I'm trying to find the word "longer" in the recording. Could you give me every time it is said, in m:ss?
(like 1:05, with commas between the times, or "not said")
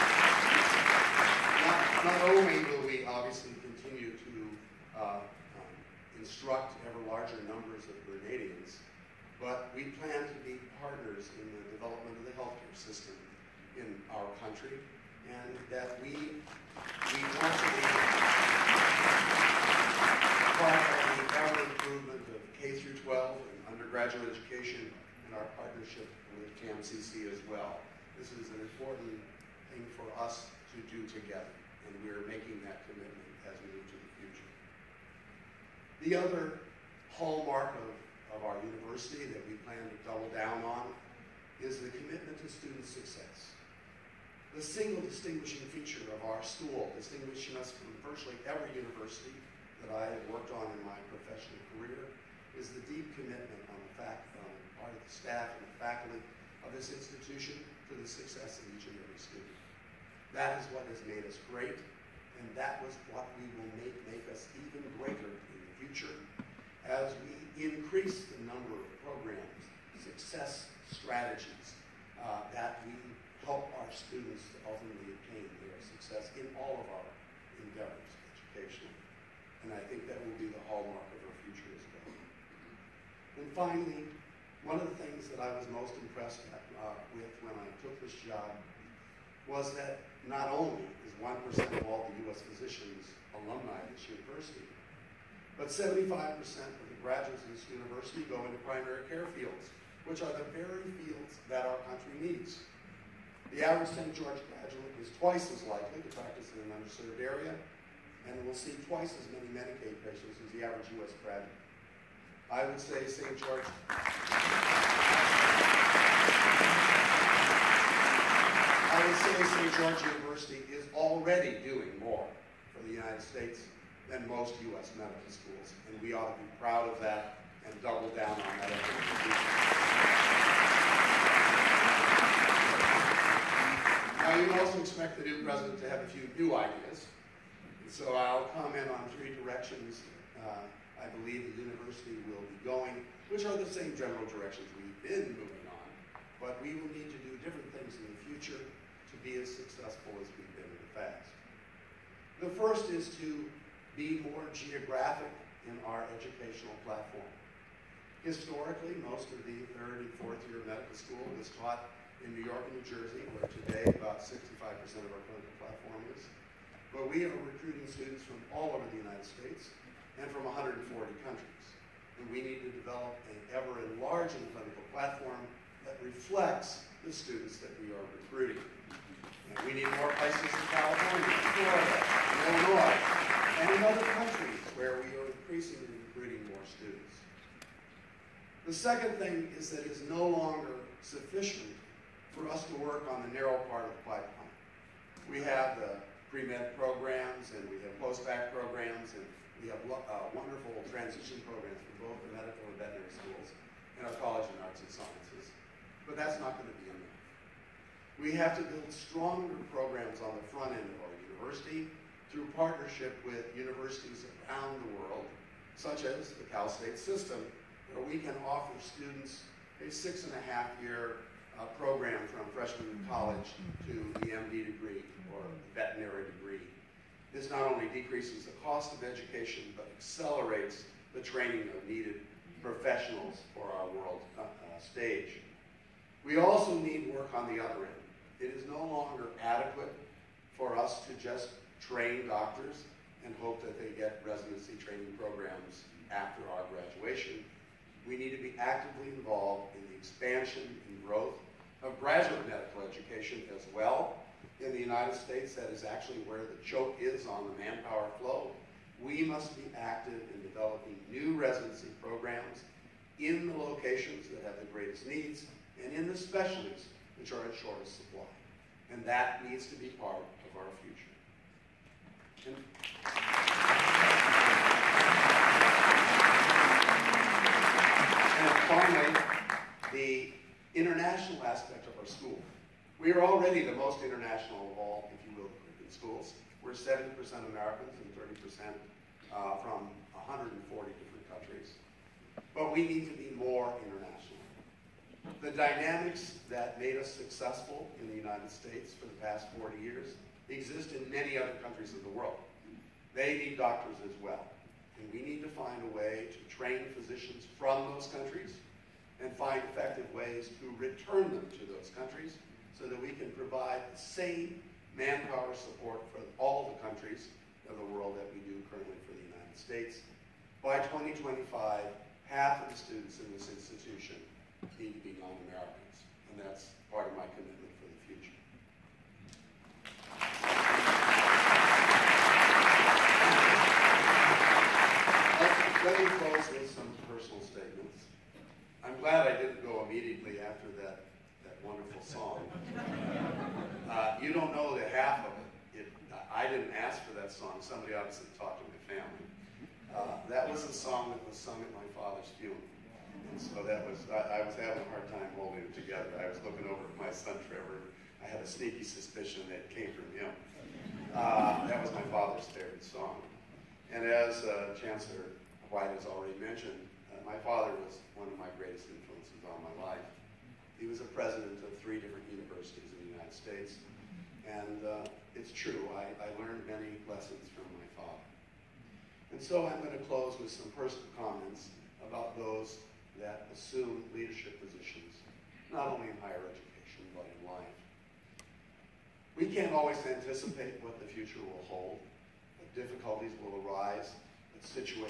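3:10, 3:58.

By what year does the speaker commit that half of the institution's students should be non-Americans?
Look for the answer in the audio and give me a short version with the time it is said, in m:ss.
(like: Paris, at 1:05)
2025, at 5:20.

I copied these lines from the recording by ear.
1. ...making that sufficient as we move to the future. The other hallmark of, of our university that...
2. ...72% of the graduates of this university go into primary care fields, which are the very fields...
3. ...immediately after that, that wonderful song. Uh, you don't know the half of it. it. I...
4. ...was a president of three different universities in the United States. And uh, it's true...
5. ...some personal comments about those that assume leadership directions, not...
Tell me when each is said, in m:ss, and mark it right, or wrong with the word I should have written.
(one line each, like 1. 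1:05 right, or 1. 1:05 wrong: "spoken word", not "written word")
1. 0:32 wrong: "commitment", not "sufficient"
2. 1:35 wrong: "75", not "72"
3. 5:39 right
4. 6:10 right
5. 6:20 wrong: "positions", not "directions".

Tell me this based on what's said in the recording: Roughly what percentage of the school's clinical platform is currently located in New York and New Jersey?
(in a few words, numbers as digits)
65%.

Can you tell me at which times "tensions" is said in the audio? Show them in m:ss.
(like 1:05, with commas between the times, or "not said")
not said.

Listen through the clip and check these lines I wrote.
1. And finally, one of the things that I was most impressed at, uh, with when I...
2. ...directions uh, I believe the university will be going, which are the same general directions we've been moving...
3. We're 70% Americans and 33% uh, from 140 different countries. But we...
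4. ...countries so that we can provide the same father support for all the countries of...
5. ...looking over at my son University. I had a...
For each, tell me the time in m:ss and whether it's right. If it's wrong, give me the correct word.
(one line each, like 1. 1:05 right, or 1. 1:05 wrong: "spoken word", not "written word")
1. 1:23 right
2. 2:19 right
3. 4:46 wrong: "30", not "33"
4. 5:11 wrong: "manpower", not "father"
5. 5:56 wrong: "Trevor", not "University".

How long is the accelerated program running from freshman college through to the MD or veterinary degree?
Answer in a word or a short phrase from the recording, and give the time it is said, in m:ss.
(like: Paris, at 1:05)
6 and a half years, at 3:39.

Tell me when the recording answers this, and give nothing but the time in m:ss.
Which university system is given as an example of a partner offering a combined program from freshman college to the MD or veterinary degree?
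3:36.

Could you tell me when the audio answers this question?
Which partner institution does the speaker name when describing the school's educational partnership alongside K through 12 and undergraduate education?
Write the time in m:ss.
0:26.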